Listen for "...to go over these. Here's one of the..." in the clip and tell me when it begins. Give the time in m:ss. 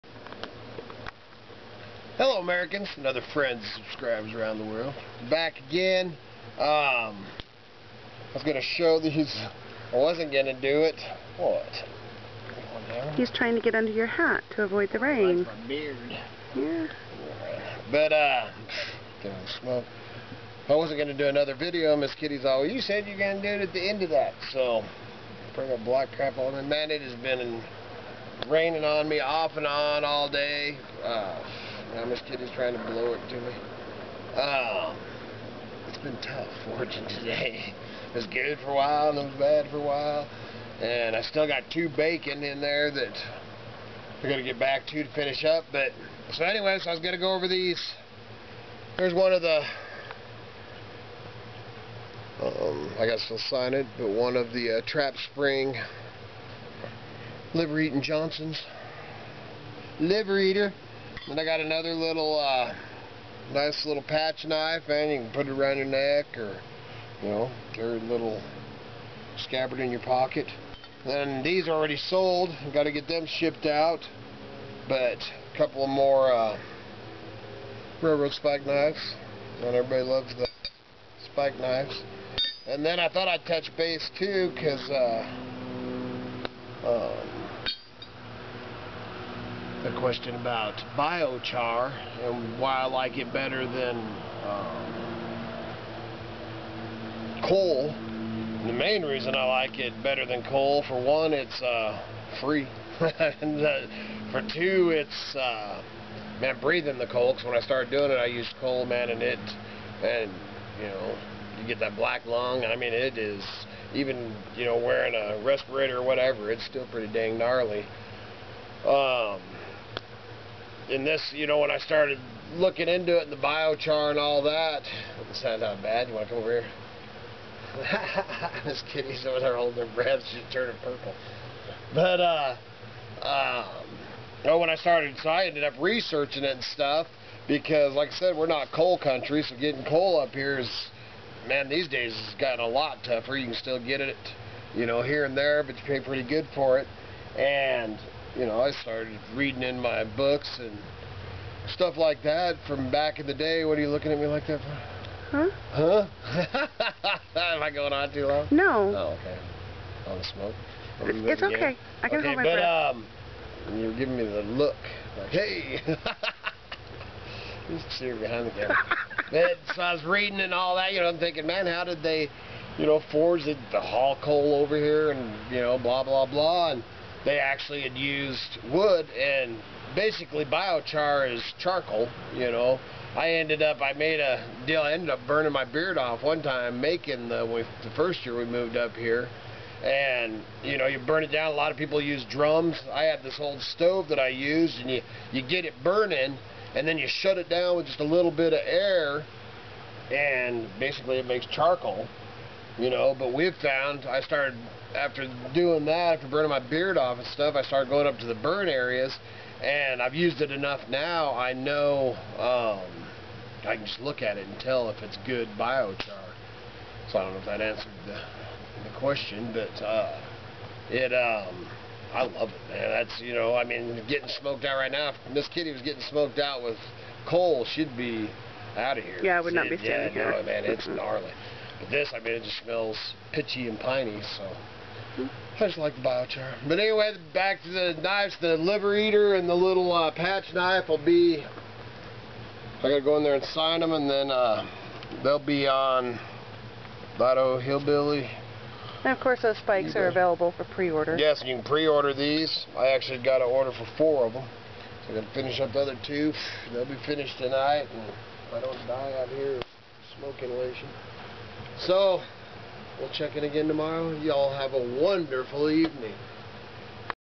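0:47.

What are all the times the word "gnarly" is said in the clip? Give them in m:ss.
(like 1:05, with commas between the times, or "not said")
1:57, 3:50.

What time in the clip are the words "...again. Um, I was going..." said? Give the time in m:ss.
0:05.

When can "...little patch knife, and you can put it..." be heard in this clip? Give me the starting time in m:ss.
1:03.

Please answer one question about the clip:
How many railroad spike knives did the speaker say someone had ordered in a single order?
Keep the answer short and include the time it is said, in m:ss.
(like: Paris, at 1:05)
4, at 4:13.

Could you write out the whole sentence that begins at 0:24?
So, bring a black crap on.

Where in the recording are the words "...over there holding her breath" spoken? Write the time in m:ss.
2:09.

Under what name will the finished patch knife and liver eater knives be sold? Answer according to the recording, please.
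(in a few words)
Idaho Hillbilly.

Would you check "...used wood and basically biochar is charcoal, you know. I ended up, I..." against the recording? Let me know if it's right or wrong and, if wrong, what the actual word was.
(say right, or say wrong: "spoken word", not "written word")
right.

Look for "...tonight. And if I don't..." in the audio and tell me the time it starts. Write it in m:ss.
4:17.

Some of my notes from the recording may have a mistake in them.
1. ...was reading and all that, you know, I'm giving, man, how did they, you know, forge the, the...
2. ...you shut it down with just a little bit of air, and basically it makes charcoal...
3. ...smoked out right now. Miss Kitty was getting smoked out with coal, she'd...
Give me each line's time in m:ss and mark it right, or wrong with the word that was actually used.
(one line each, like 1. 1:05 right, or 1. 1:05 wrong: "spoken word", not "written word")
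1. 2:49 wrong: "thinking", not "giving"
2. 3:16 right
3. 3:44 right.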